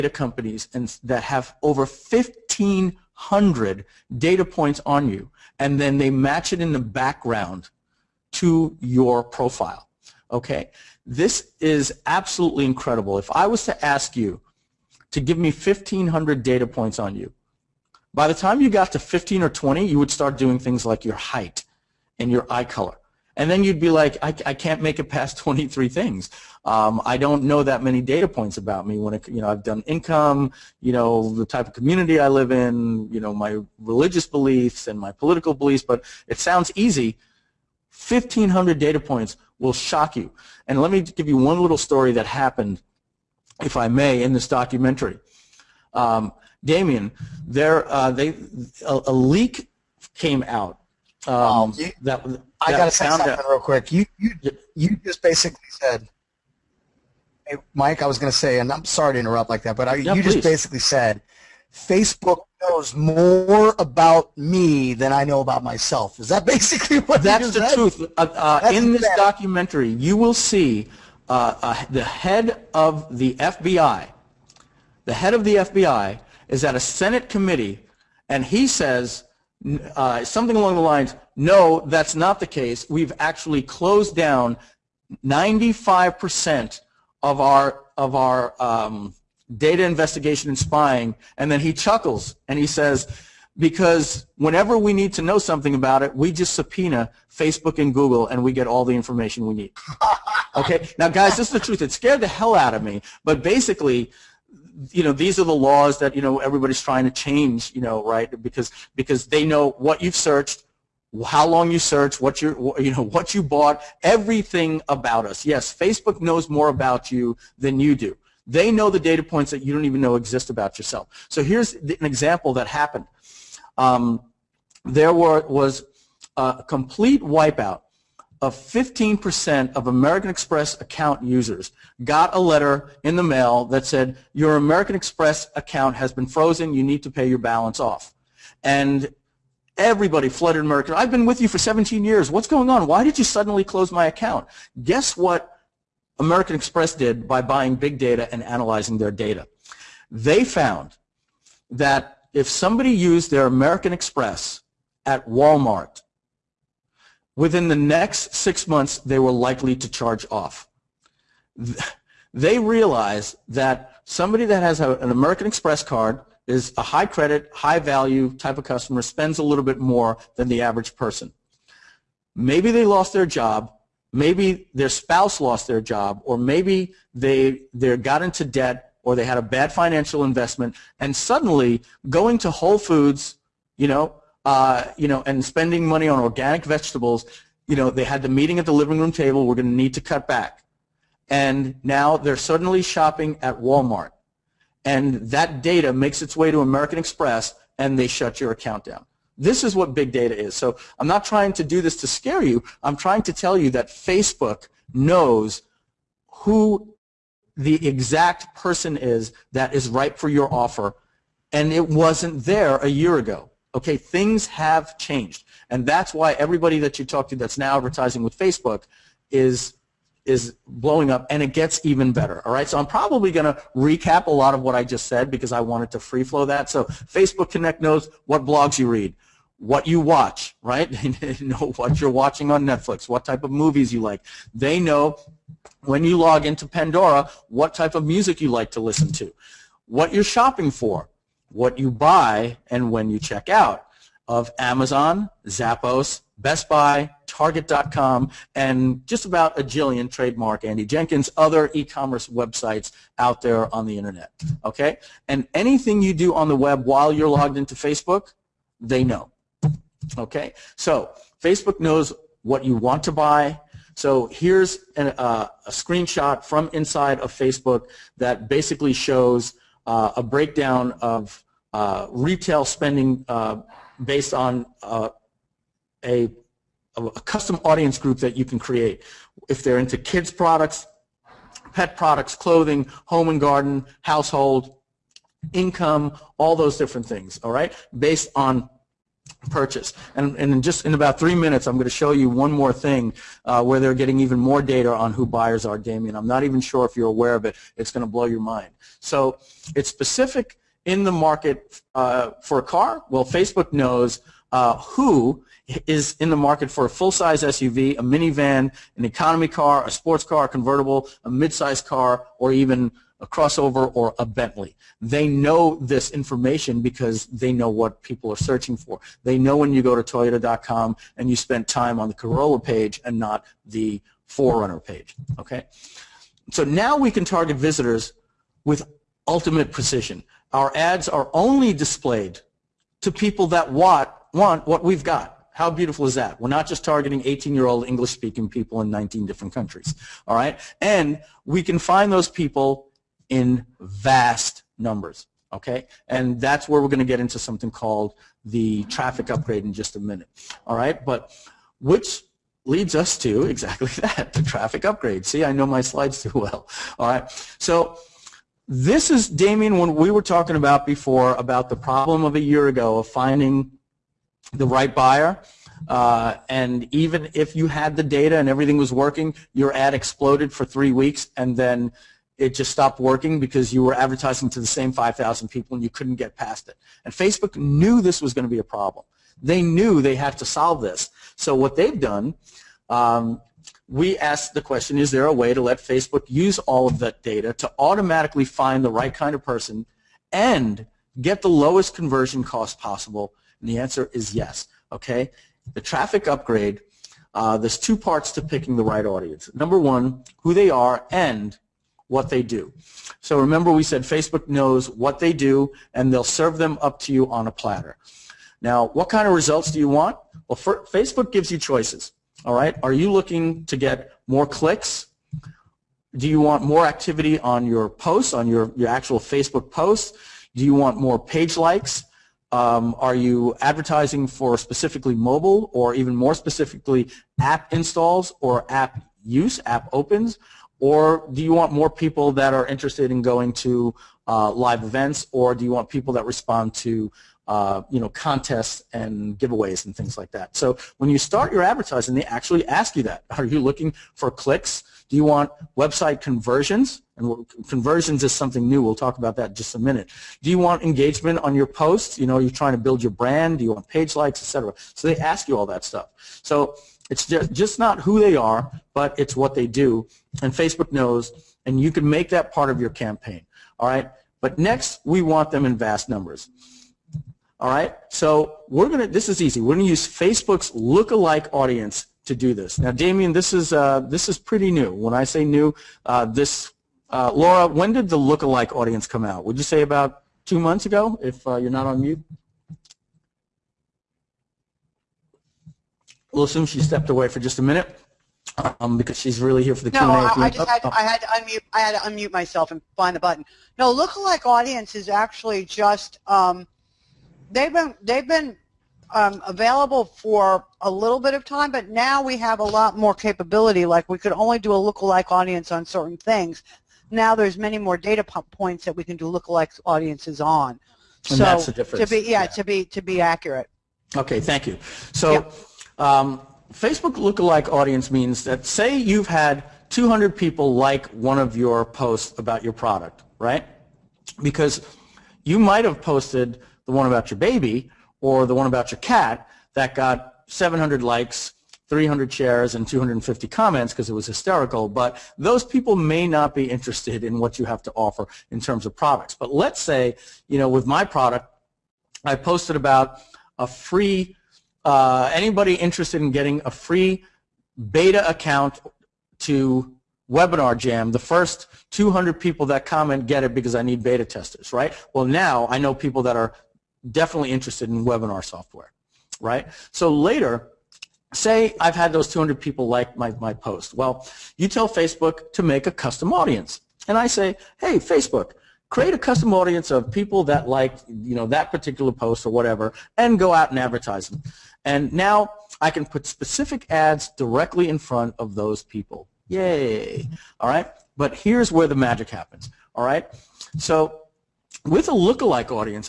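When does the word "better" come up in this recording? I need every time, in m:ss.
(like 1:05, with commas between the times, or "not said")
3:42.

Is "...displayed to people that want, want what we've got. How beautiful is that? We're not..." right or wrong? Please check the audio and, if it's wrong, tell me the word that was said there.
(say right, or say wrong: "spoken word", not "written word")
right.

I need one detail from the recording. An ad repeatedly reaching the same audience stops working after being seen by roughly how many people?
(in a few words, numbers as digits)
5,000.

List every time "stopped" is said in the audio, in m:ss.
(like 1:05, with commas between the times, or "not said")
6:12.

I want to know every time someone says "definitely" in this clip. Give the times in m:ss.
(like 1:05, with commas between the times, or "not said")
9:17.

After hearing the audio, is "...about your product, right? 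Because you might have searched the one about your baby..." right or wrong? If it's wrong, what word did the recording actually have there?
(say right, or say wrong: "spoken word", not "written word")
wrong: "posted", not "searched".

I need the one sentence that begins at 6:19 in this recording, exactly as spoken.
They knew they had to solve this.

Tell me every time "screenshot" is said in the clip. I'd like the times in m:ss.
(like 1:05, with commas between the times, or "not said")
4:25.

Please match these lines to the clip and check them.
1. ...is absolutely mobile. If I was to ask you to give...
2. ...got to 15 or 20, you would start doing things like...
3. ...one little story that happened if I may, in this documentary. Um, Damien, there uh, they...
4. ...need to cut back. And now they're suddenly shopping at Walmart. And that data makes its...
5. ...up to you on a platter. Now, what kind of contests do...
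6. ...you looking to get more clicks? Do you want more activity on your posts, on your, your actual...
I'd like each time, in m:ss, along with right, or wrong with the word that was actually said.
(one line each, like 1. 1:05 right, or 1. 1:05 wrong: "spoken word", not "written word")
1. 0:11 wrong: "incredible", not "mobile"
2. 0:18 right
3. 0:41 right
4. 3:09 right
5. 6:46 wrong: "results", not "contests"
6. 6:52 right.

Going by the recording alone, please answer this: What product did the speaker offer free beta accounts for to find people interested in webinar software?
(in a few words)
WebinarJam.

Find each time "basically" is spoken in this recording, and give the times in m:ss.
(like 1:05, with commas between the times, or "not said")
0:55, 1:00, 1:06, 1:43, 4:28.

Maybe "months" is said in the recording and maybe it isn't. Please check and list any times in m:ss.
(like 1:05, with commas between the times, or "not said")
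2:38, 8:00.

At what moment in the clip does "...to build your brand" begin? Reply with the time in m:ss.
7:32.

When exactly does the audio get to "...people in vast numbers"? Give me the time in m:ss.
5:42.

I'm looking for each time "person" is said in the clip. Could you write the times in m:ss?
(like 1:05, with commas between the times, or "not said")
2:50, 3:28, 6:29.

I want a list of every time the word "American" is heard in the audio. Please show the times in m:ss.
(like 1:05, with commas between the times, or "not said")
2:09, 2:14, 2:20, 2:26, 2:33, 2:45, 3:16.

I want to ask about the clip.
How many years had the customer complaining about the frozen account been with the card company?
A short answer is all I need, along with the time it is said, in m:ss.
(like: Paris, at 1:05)
17, at 2:21.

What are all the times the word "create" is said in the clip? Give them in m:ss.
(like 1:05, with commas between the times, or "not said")
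4:38, 9:28.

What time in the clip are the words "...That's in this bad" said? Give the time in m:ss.
1:08.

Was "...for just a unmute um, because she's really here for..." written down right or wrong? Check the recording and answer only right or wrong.
wrong.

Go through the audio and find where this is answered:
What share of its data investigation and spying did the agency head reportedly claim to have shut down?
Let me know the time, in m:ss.
1:25.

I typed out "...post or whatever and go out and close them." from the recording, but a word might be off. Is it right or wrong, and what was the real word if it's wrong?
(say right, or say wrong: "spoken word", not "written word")
wrong: "advertise", not "close".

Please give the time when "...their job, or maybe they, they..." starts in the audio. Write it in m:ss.
2:55.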